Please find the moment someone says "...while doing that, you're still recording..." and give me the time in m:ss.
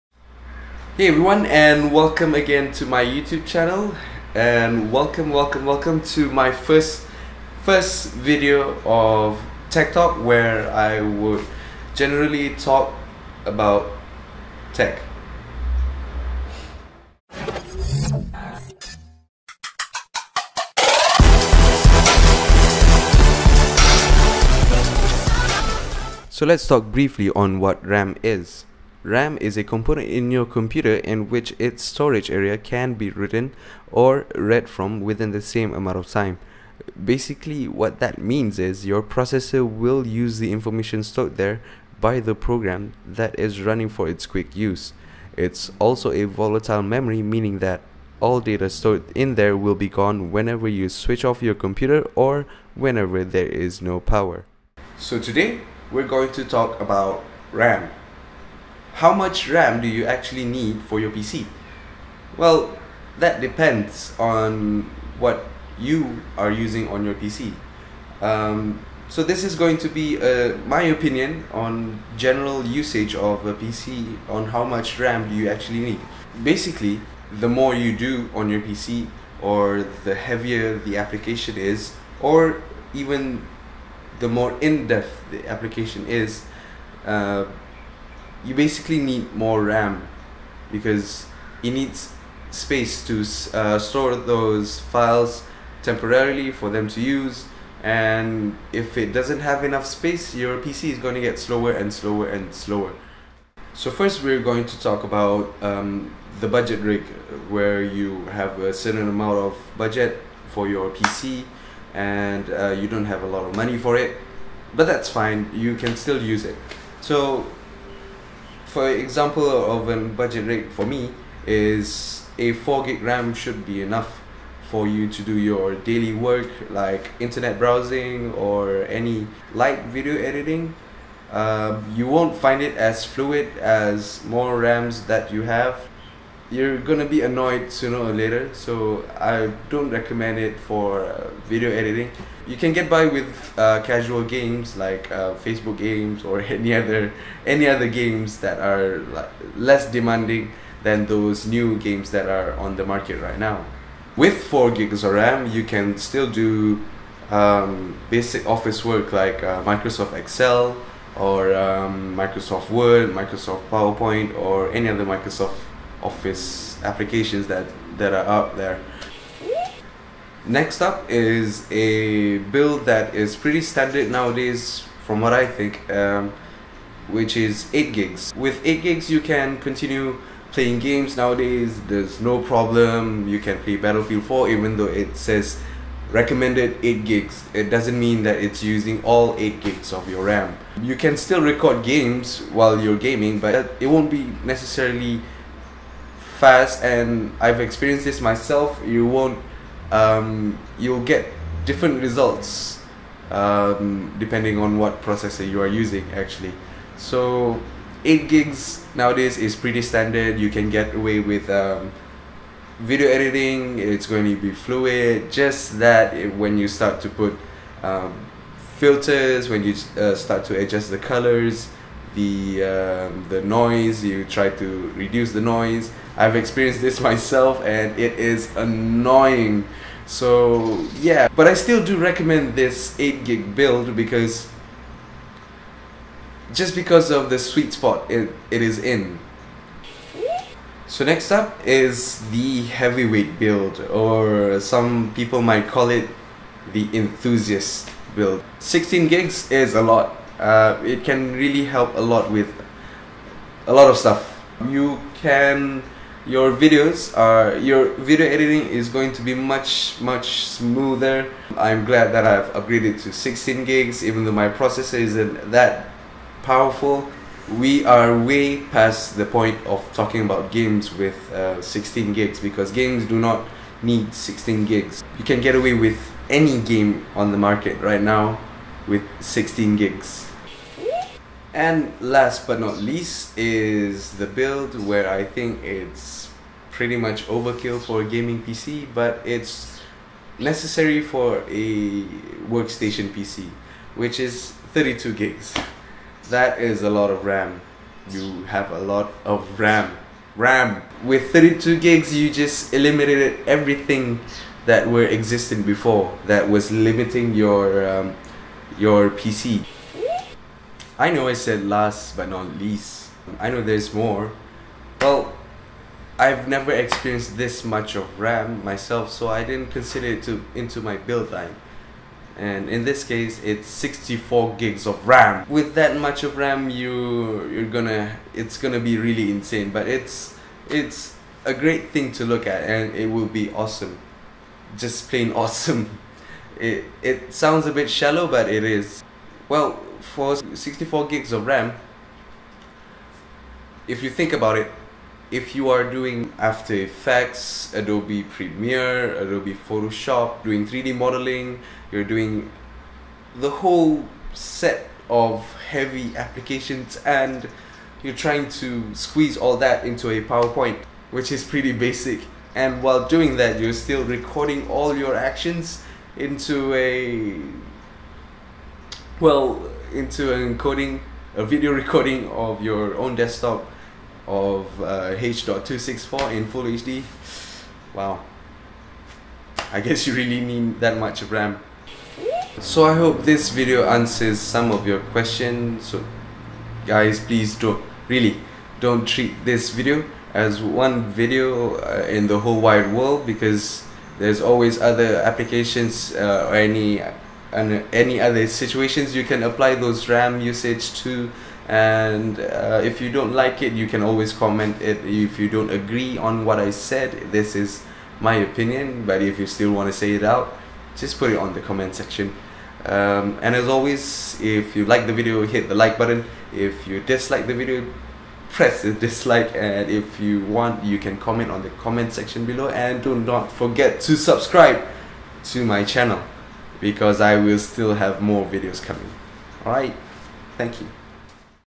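6:02.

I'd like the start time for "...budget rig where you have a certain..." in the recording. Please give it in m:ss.
1:46.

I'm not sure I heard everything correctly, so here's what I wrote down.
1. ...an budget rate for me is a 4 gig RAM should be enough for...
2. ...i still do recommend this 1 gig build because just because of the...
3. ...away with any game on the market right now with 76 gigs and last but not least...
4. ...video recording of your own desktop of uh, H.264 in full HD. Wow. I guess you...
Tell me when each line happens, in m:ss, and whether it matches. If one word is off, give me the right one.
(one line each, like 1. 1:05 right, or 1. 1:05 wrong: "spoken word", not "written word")
1. 1:59 right
2. 3:51 wrong: "8", not "1"
3. 4:35 wrong: "16", not "76"
4. 6:11 right.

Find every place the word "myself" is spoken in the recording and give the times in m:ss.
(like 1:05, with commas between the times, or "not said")
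3:18, 3:46, 5:18.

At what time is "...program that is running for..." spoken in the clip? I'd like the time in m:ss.
0:42.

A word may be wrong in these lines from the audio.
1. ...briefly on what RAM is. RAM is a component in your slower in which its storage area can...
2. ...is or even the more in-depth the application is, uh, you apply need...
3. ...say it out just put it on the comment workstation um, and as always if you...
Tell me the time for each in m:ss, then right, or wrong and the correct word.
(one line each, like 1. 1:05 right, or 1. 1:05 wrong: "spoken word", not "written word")
1. 0:26 wrong: "computer", not "slower"
2. 1:21 wrong: "basically", not "apply"
3. 6:49 wrong: "section", not "workstation".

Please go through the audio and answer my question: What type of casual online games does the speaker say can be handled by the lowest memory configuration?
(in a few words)
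Facebook games.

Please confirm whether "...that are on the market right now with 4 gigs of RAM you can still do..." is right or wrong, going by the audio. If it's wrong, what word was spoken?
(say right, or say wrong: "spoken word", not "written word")
right.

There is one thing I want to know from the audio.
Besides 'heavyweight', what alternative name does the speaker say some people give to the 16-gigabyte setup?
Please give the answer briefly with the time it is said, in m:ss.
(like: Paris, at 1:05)
enthusiast build, at 4:06.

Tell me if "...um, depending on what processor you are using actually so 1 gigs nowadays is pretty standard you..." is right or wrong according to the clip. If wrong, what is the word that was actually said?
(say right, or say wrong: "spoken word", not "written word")
wrong: "8", not "1".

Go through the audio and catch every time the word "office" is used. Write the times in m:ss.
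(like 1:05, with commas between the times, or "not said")
2:38, 2:46.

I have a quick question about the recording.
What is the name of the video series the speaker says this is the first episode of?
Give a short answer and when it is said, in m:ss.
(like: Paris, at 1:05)
Tech Talk, at 0:09.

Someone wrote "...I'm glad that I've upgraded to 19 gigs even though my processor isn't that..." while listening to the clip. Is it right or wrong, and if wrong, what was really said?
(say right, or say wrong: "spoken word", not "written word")
wrong: "16", not "19".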